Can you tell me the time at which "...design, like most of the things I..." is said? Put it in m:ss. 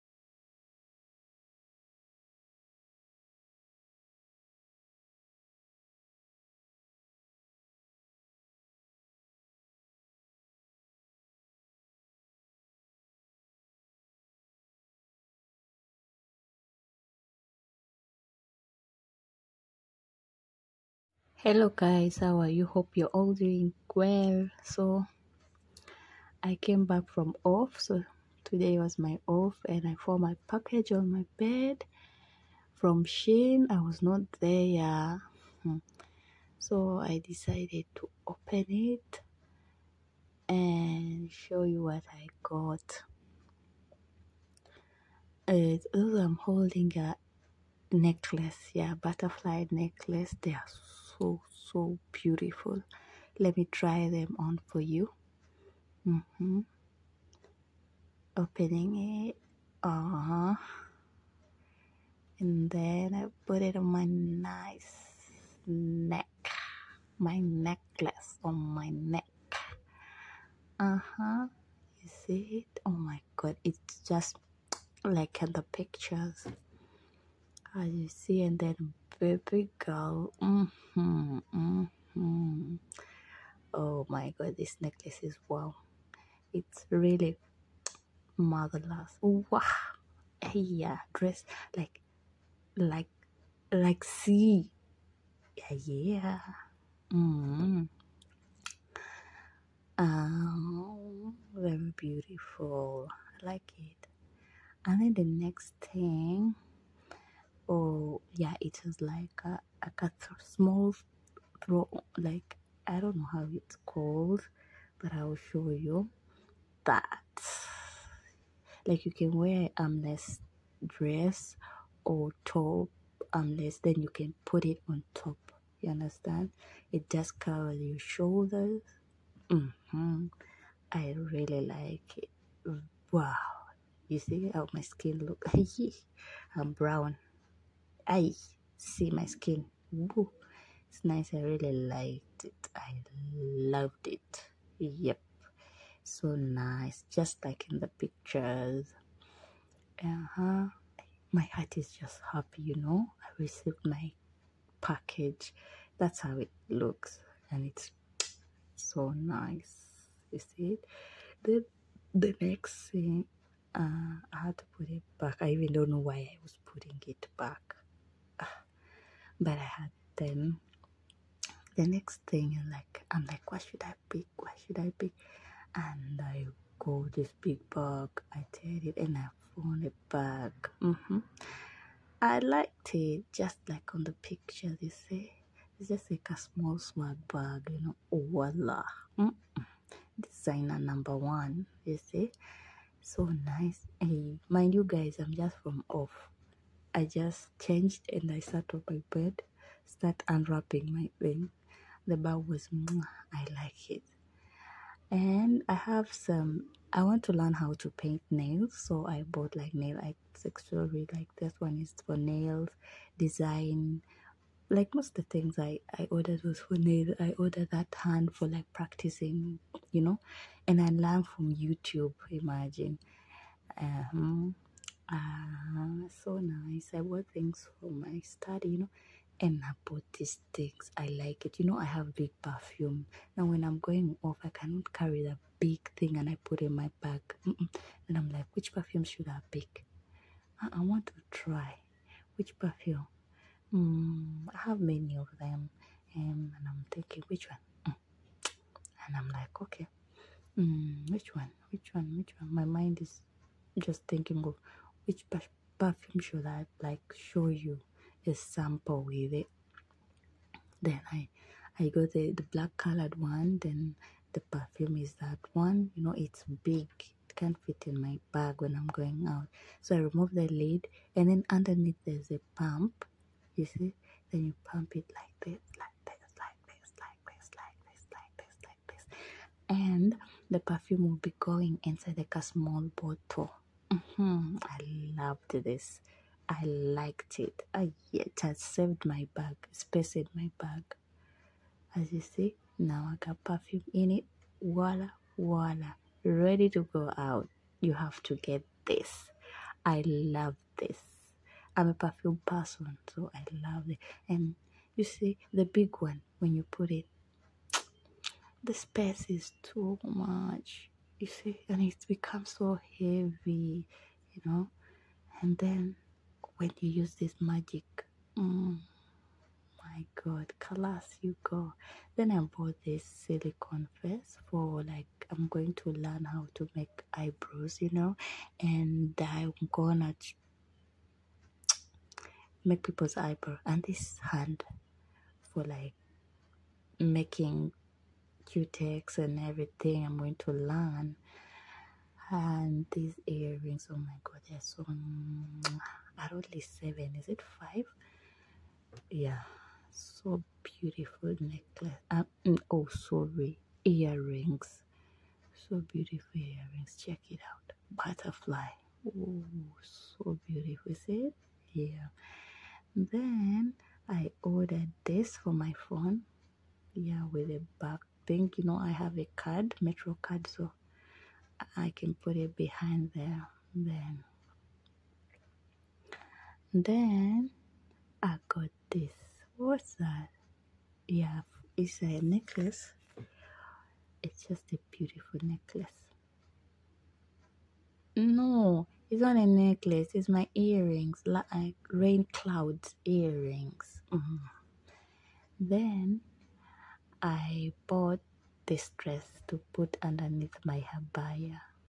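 3:33.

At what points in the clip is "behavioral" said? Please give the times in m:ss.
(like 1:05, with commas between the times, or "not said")
not said.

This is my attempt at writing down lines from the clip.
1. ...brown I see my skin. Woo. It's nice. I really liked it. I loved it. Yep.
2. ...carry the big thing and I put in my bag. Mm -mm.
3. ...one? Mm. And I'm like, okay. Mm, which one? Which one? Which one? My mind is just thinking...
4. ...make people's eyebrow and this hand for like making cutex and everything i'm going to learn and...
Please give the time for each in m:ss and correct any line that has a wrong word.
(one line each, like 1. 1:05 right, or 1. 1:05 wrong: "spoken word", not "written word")
1. 2:16 right
2. 3:54 right
3. 4:07 right
4. 5:32 right.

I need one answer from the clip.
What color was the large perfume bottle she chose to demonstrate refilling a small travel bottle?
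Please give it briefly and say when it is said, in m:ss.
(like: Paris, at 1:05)
Black, at 4:22.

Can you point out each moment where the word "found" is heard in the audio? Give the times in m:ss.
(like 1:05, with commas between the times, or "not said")
0:30, 2:59.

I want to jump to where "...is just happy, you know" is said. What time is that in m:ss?
2:31.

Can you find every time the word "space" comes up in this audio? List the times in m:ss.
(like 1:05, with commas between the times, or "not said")
4:49, 5:08.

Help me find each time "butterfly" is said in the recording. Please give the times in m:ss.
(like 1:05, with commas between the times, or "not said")
0:48, 5:57.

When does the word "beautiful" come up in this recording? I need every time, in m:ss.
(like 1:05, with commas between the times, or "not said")
0:52, 1:41, 5:50, 5:55, 6:00, 6:24.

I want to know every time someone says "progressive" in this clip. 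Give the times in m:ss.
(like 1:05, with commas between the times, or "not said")
not said.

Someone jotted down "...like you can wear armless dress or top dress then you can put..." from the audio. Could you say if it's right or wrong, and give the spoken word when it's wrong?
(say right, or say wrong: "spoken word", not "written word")
wrong: "armless", not "dress".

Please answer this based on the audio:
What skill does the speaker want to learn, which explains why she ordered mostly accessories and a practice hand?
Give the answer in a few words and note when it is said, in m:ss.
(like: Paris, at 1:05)
Paint nails, at 3:27.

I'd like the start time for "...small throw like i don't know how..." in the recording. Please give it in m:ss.
1:50.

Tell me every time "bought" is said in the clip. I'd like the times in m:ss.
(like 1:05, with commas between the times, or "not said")
3:29, 3:49, 5:22, 6:37.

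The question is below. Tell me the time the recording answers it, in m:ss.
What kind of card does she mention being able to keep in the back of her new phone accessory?
6:09.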